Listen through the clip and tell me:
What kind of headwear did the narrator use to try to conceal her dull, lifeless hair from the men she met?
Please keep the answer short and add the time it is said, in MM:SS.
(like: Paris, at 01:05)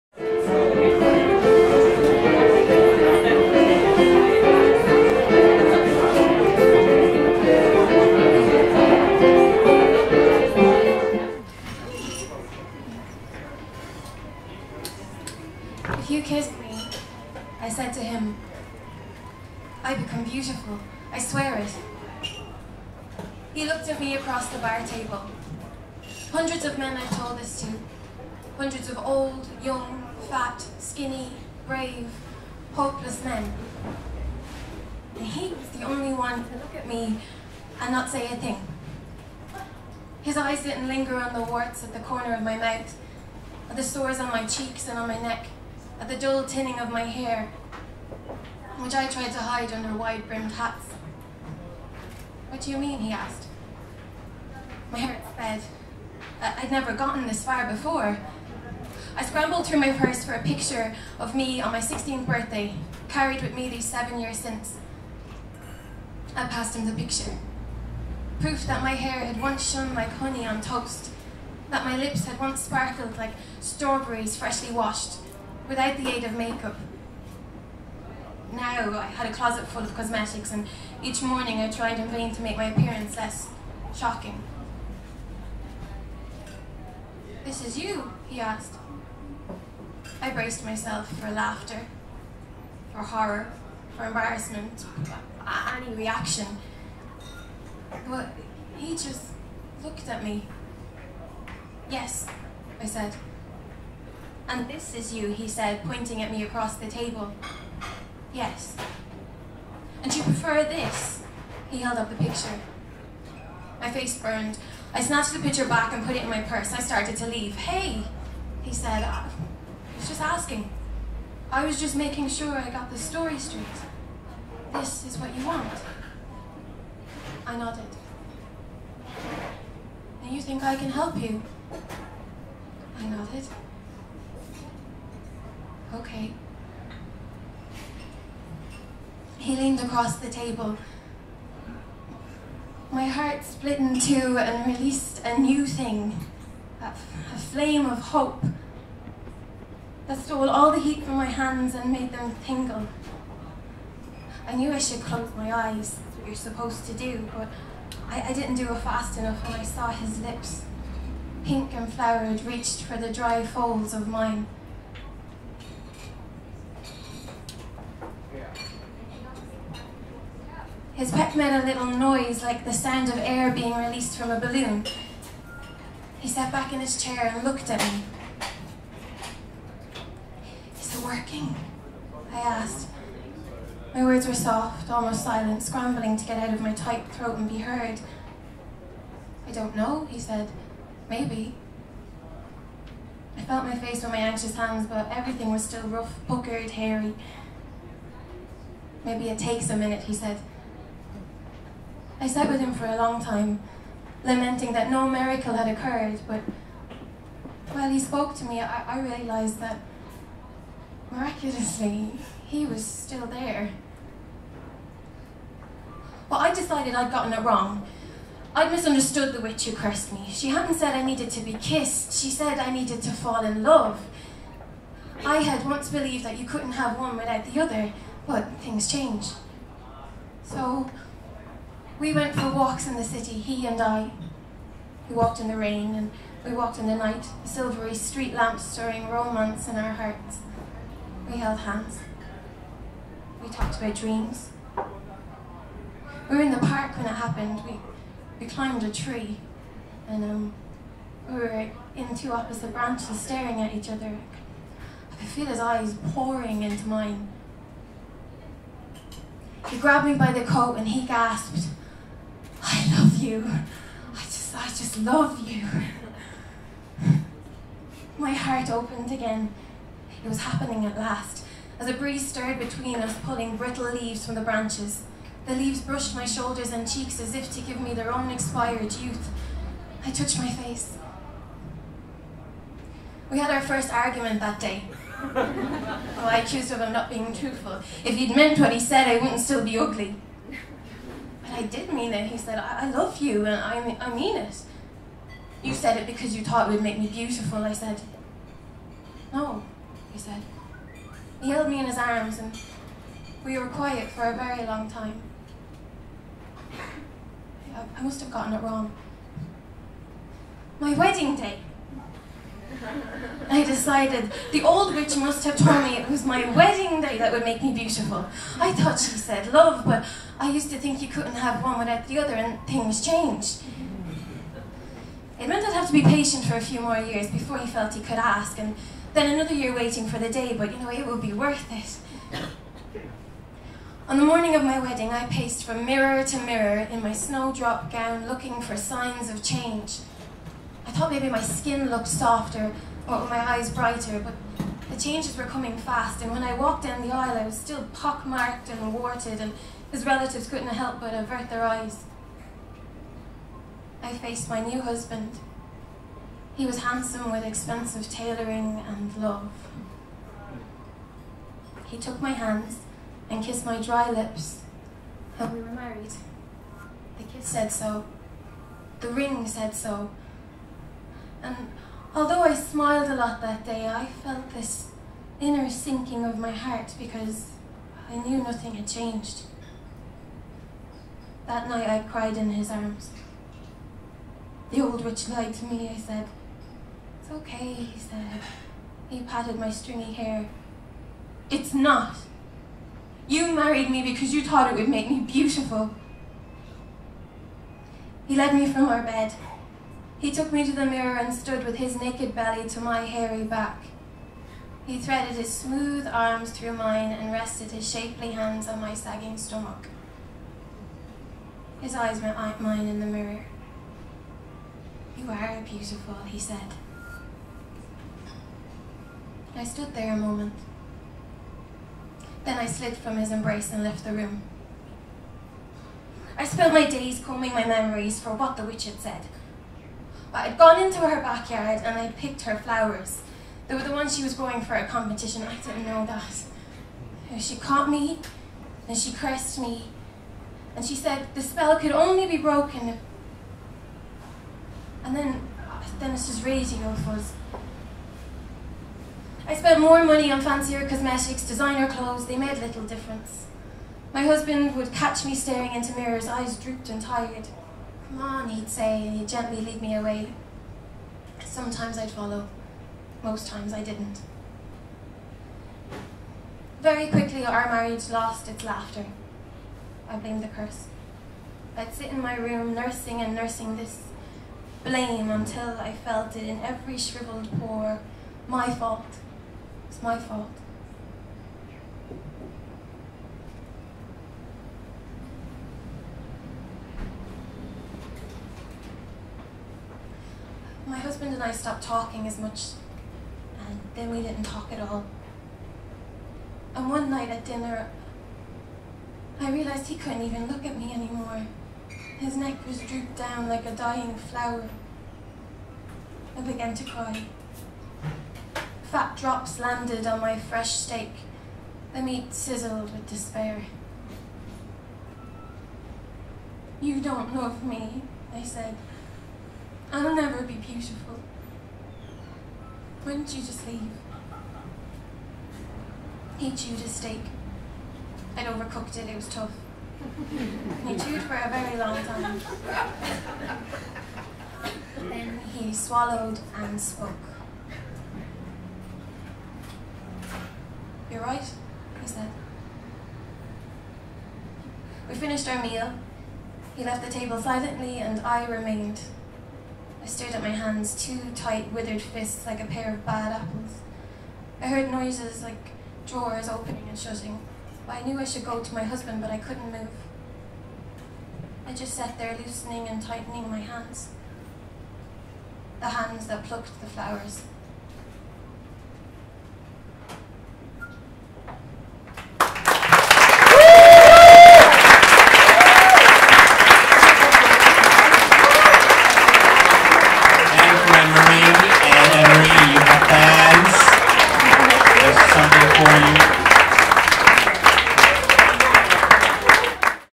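wide-brimmed hats, at 00:49.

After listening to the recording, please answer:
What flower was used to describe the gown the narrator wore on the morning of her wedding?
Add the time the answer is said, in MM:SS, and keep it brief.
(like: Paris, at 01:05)
snowdrop, at 05:37.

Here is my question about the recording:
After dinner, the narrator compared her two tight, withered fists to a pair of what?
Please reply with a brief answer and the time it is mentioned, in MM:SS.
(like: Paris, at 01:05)
bad apples, at 09:13.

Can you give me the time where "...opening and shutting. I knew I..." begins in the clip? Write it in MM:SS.
09:16.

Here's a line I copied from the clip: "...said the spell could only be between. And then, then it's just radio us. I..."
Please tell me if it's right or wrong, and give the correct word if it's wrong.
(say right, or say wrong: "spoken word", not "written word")
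wrong: "broken", not "between".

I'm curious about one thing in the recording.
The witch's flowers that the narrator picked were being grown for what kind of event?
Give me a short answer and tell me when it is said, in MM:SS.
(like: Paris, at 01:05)
a competition, at 07:14.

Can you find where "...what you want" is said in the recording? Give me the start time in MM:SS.
02:05.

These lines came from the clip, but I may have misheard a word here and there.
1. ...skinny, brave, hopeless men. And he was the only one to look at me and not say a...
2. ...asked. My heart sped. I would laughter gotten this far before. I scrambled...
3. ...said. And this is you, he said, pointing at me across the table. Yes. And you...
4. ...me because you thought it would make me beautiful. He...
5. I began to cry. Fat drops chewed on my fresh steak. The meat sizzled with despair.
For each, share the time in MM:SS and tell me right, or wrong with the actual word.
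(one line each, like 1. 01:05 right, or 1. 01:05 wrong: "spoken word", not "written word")
1. 00:30 right
2. 00:53 wrong: "never", not "laughter"
3. 01:42 right
4. 06:33 right
5. 08:26 wrong: "landed", not "chewed".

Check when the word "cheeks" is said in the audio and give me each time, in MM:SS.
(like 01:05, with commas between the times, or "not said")
00:44, 04:36.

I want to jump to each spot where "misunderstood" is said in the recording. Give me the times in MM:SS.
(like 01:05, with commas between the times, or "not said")
03:38.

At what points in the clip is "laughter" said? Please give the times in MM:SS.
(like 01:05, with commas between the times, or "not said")
01:31, 07:48.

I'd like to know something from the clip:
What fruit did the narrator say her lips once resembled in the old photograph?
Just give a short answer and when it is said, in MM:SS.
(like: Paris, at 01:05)
strawberries, at 01:13.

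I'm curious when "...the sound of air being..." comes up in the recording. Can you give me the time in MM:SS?
02:52.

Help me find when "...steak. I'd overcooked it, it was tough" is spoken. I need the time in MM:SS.
08:46.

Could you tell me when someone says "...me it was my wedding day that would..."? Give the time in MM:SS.
05:15.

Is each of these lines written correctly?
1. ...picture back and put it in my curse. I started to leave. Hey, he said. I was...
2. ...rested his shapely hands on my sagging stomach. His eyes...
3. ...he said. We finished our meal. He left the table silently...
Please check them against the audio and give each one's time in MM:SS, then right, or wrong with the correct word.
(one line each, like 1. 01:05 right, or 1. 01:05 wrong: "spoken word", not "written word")
1. 01:55 wrong: "purse", not "curse"
2. 06:47 right
3. 09:02 right.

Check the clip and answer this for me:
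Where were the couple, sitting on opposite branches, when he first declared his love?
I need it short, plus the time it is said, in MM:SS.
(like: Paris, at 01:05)
the park, at 04:06.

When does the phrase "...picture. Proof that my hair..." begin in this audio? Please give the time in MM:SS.
01:06.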